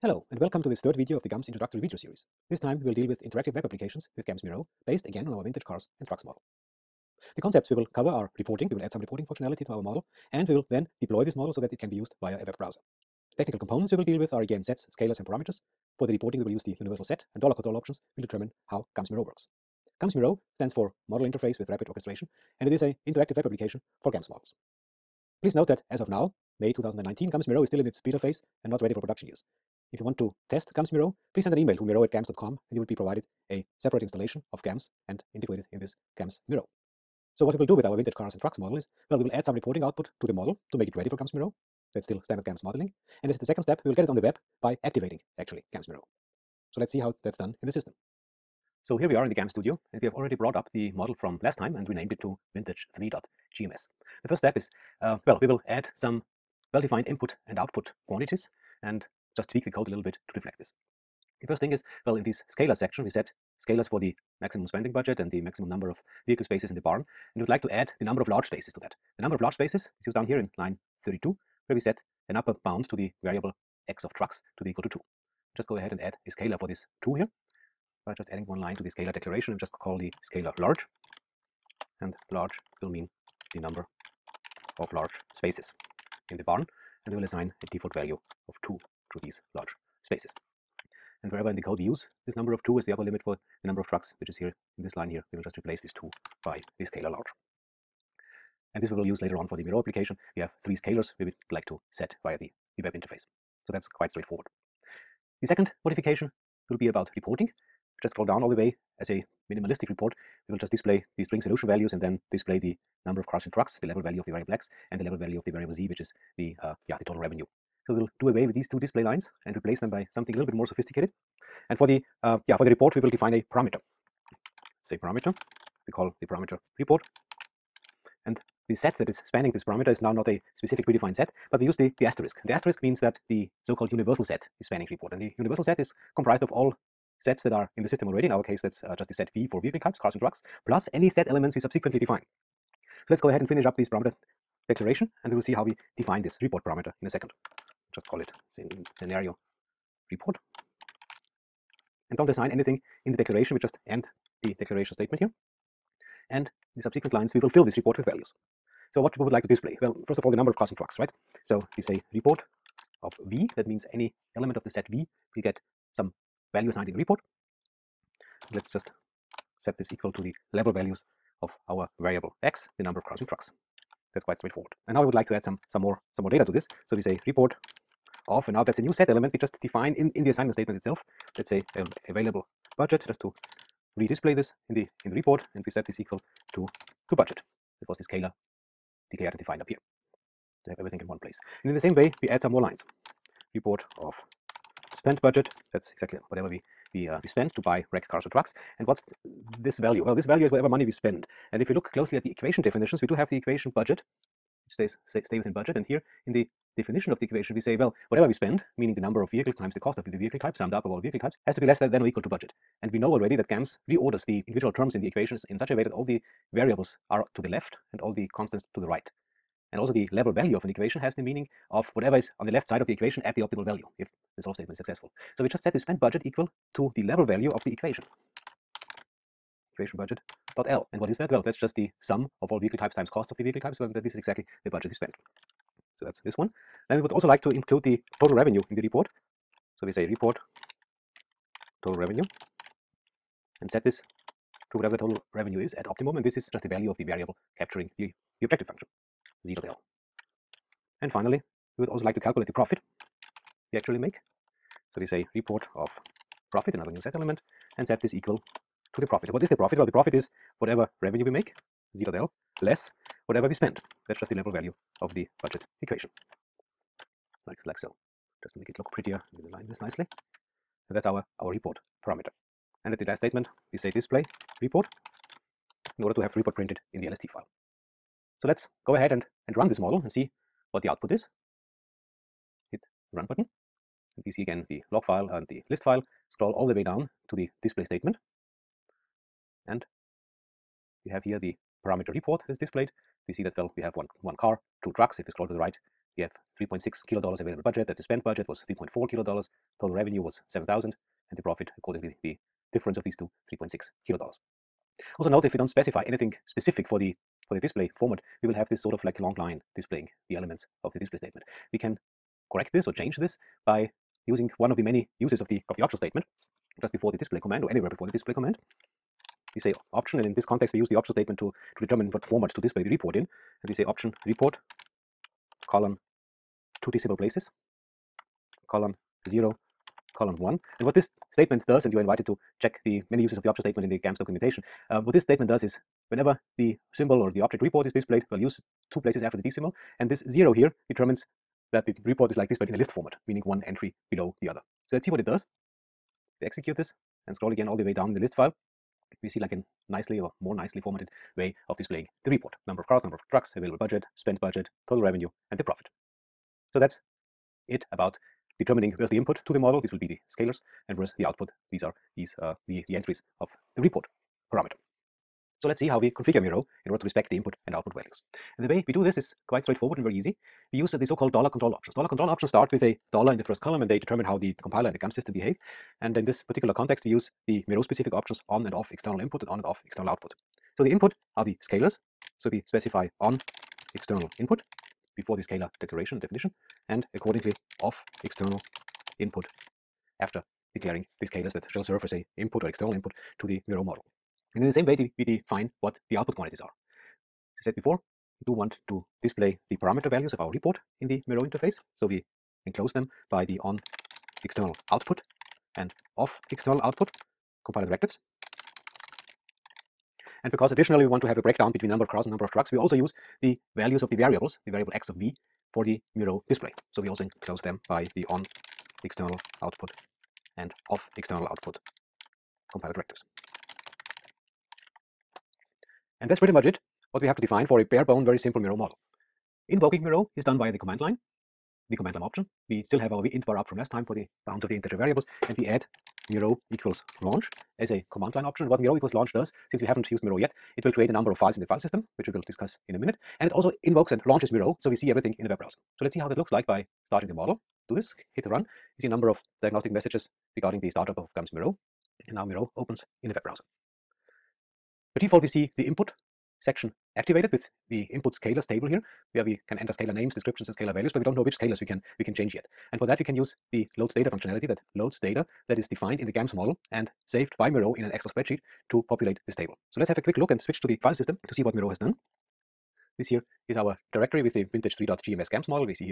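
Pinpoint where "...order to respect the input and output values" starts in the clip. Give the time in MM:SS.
06:06.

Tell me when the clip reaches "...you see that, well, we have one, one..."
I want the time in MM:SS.
04:53.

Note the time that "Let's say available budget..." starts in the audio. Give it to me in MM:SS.
03:01.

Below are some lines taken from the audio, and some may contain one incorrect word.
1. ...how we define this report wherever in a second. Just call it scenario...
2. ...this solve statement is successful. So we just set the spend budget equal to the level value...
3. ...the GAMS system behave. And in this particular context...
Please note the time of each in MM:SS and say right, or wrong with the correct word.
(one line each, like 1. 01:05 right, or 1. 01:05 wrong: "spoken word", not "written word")
1. 02:25 wrong: "parameter", not "wherever"
2. 03:44 right
3. 06:14 right.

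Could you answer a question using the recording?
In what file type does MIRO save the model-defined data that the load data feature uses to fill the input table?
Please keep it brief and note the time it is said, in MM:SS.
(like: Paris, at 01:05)
Excel spreadsheet, at 07:48.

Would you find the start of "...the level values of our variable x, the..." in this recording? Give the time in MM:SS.
02:50.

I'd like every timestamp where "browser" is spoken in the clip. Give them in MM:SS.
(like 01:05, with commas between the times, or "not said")
00:12, 07:25, 07:33.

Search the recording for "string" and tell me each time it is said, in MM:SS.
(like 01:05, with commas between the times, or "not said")
01:51.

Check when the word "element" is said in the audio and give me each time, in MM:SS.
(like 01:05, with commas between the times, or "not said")
02:21, 02:44, 02:59, 04:17, 05:10.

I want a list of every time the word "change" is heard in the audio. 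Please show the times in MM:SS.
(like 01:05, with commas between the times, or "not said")
05:12, 07:42.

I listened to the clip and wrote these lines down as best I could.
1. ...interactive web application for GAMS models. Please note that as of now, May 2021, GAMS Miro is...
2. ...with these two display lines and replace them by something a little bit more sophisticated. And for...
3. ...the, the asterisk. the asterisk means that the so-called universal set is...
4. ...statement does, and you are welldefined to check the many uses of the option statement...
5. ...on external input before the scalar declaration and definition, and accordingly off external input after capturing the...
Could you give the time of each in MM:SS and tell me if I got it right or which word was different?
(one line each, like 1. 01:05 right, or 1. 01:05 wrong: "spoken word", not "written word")
1. 00:23 wrong: "2019", not "2021"
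2. 01:58 right
3. 02:11 right
4. 05:31 wrong: "invited", not "welldefined"
5. 06:23 wrong: "declaring", not "capturing".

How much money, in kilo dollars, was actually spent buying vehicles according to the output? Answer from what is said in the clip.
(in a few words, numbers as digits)
3.4.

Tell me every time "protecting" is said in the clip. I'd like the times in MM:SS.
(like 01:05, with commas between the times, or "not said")
not said.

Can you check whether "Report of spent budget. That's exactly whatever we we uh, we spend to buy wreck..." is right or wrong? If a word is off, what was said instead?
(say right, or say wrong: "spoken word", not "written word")
right.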